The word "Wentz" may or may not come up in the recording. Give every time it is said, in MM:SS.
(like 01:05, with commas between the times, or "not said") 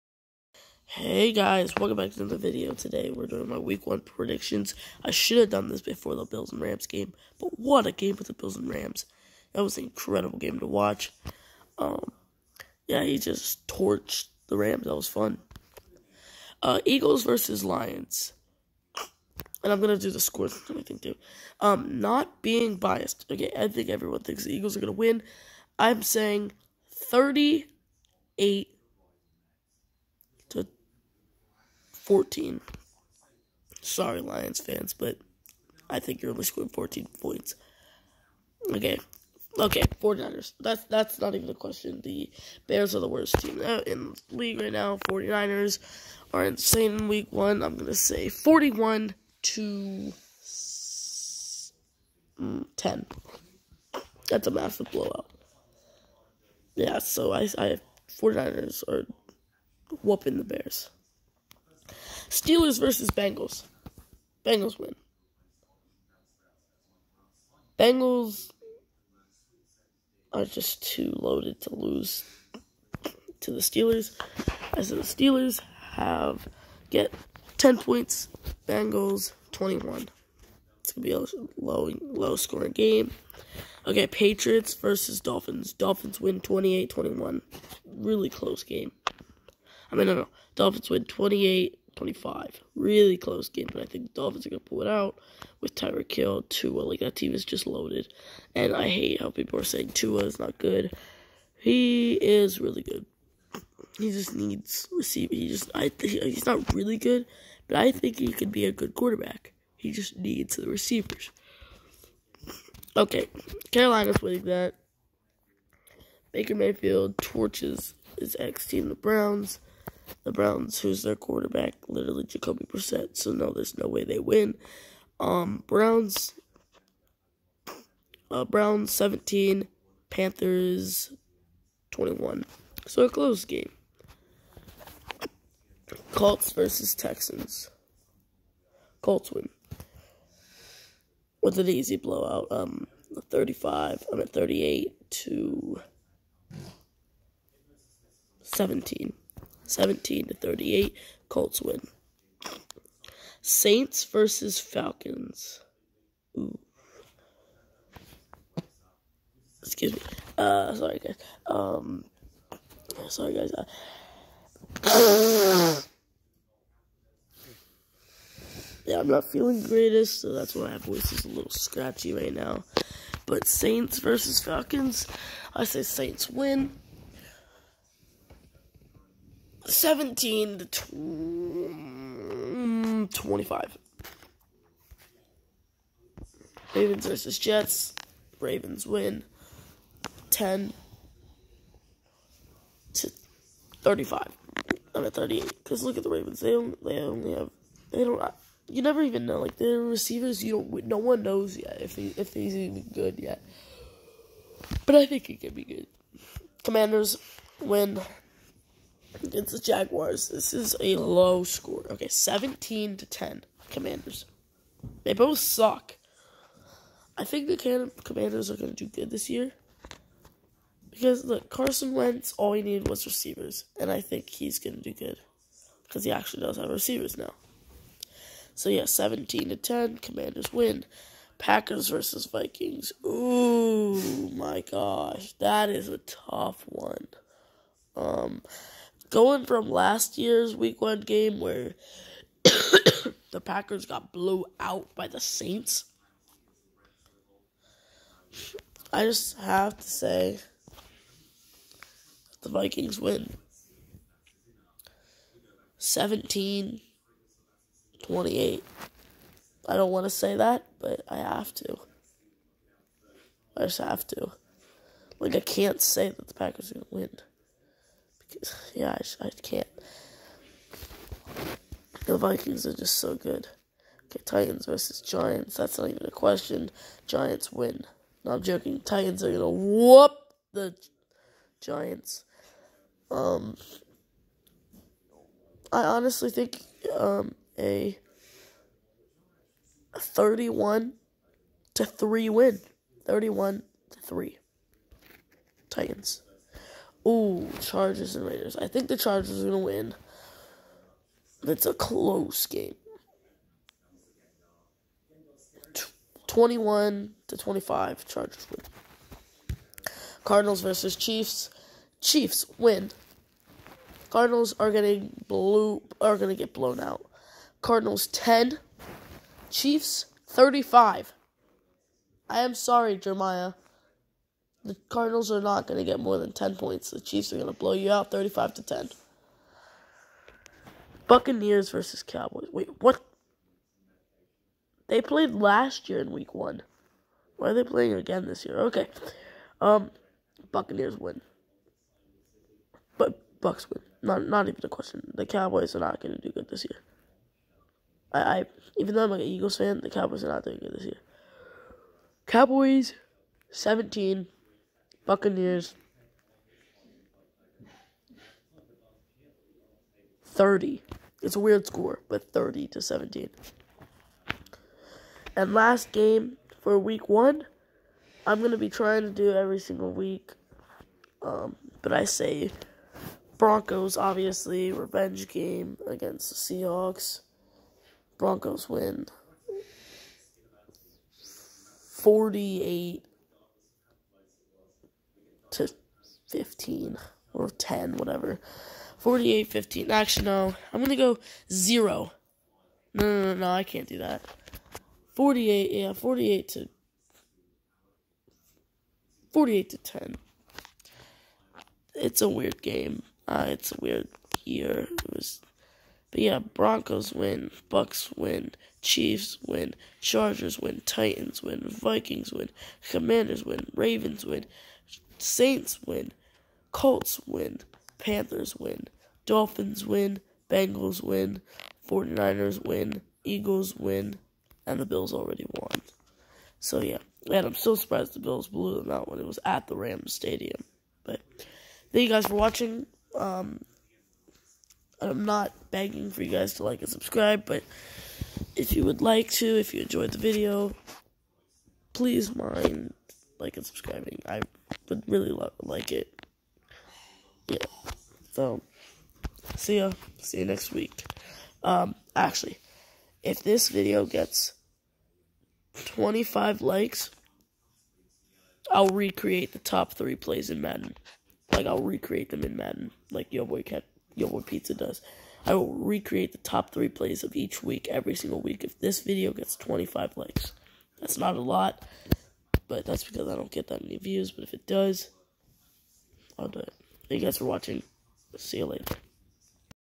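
03:41.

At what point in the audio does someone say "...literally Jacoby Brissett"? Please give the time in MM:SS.
02:01.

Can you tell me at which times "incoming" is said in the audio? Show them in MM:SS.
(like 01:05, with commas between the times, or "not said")
not said.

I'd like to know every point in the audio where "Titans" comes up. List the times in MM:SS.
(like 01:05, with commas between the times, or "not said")
04:34, 04:38, 04:55, 06:50.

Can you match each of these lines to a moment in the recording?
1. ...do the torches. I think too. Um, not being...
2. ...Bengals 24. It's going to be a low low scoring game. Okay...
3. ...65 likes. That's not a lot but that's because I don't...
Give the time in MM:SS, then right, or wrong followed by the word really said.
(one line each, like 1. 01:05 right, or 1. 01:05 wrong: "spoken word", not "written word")
1. 00:19 wrong: "scores", not "torches"
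2. 01:18 wrong: "21", not "24"
3. 07:49 wrong: "25", not "65".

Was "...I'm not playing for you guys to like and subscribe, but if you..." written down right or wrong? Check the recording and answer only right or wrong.
wrong.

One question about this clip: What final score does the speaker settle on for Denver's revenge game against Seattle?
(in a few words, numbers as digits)
48 to 10.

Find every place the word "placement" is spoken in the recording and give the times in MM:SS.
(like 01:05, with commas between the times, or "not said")
not said.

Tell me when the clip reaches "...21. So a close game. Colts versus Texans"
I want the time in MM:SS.
02:11.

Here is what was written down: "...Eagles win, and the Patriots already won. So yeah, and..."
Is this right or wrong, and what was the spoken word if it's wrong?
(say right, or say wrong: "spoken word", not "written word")
wrong: "Bills", not "Patriots".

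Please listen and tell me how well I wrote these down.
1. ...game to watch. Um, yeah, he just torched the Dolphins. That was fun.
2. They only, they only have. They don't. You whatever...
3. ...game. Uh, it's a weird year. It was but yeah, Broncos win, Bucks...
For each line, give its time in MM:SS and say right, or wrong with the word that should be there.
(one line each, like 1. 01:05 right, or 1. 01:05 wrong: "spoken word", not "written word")
1. 00:10 wrong: "Rams", not "Dolphins"
2. 03:16 wrong: "never", not "whatever"
3. 06:42 right.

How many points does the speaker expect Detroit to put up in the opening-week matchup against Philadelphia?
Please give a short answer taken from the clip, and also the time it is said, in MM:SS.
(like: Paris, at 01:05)
14, at 00:36.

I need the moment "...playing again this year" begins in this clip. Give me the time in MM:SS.
05:37.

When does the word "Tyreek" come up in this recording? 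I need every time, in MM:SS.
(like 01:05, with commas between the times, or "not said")
01:35.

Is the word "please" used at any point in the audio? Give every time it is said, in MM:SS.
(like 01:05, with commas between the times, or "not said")
07:21.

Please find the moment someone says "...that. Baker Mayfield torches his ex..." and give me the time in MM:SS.
01:54.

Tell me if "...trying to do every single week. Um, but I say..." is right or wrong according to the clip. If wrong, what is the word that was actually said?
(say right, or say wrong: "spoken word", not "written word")
right.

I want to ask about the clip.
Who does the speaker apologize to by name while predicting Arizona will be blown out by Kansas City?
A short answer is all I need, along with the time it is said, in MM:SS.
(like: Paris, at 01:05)
Jeremiah, at 05:22.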